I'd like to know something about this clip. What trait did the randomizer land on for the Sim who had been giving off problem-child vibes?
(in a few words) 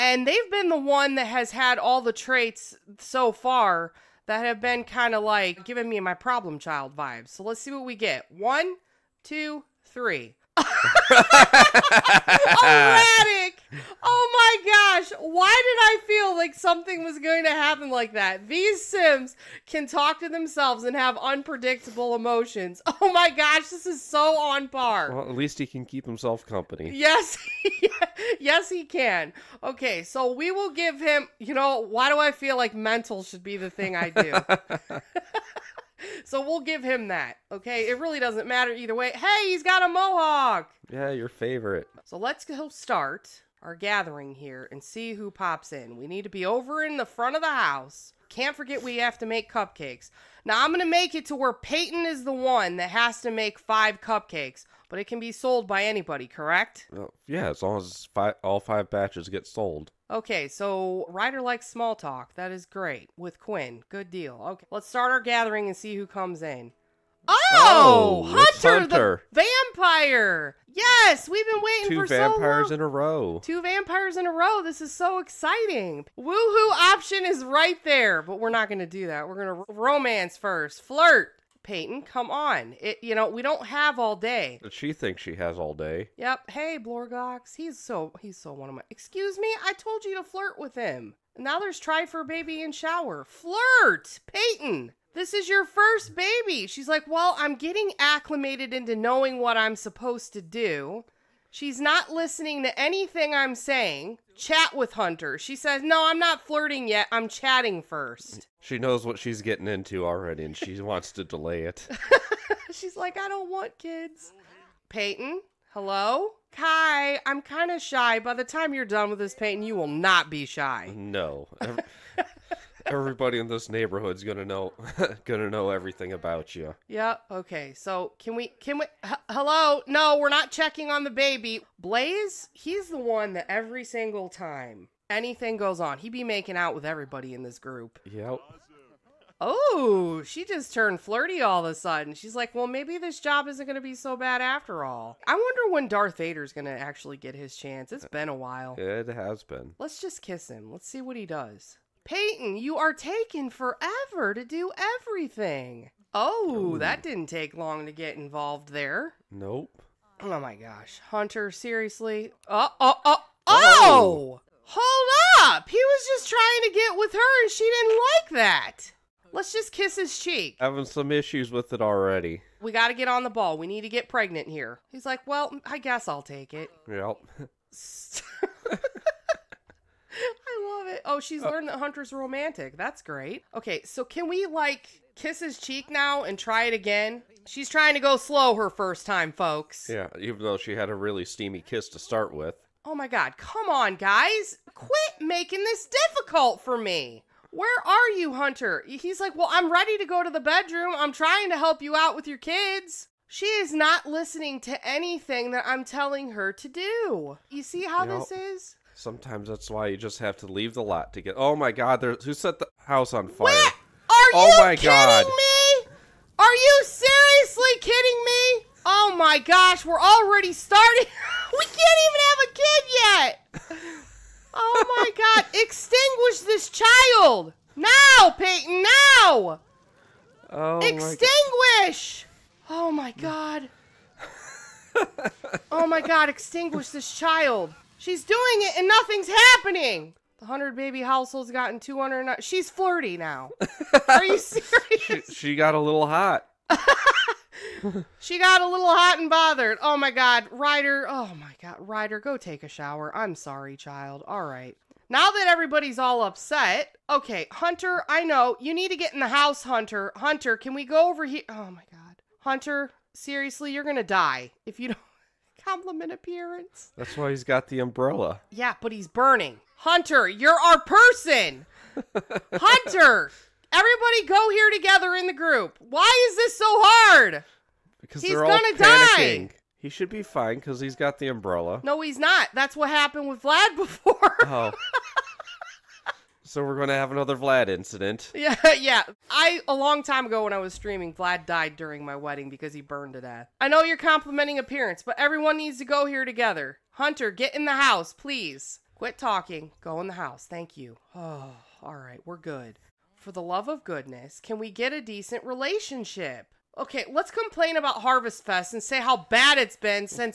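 Erratic.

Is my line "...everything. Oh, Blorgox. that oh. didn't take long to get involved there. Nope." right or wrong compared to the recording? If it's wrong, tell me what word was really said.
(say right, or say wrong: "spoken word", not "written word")
wrong: "Ooh", not "Blorgox".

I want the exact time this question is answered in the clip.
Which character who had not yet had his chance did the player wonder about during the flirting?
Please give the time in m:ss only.
2:25.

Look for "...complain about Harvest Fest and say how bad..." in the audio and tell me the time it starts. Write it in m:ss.
5:07.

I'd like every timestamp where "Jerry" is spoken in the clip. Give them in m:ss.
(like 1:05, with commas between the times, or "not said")
not said.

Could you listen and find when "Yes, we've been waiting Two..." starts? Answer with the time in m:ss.
1:10.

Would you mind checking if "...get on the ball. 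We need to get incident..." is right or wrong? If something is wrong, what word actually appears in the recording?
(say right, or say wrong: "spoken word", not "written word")
wrong: "pregnant", not "incident".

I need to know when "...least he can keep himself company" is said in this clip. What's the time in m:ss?
0:25.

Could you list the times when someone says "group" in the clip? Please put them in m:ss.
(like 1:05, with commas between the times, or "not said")
2:17, 4:35.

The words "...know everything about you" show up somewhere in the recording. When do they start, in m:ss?
2:05.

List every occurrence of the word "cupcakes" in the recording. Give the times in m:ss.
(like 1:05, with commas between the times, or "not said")
0:49, 0:53.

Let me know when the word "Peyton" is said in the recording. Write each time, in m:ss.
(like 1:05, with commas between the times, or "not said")
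0:51, 1:21, 1:34, 1:54, 1:59, 2:32, 3:48.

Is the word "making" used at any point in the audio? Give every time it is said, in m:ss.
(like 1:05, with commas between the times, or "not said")
2:16, 3:15.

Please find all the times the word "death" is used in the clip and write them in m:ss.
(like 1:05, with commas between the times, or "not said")
4:53.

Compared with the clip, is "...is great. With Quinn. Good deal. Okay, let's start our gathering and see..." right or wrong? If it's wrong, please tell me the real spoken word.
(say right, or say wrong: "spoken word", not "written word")
right.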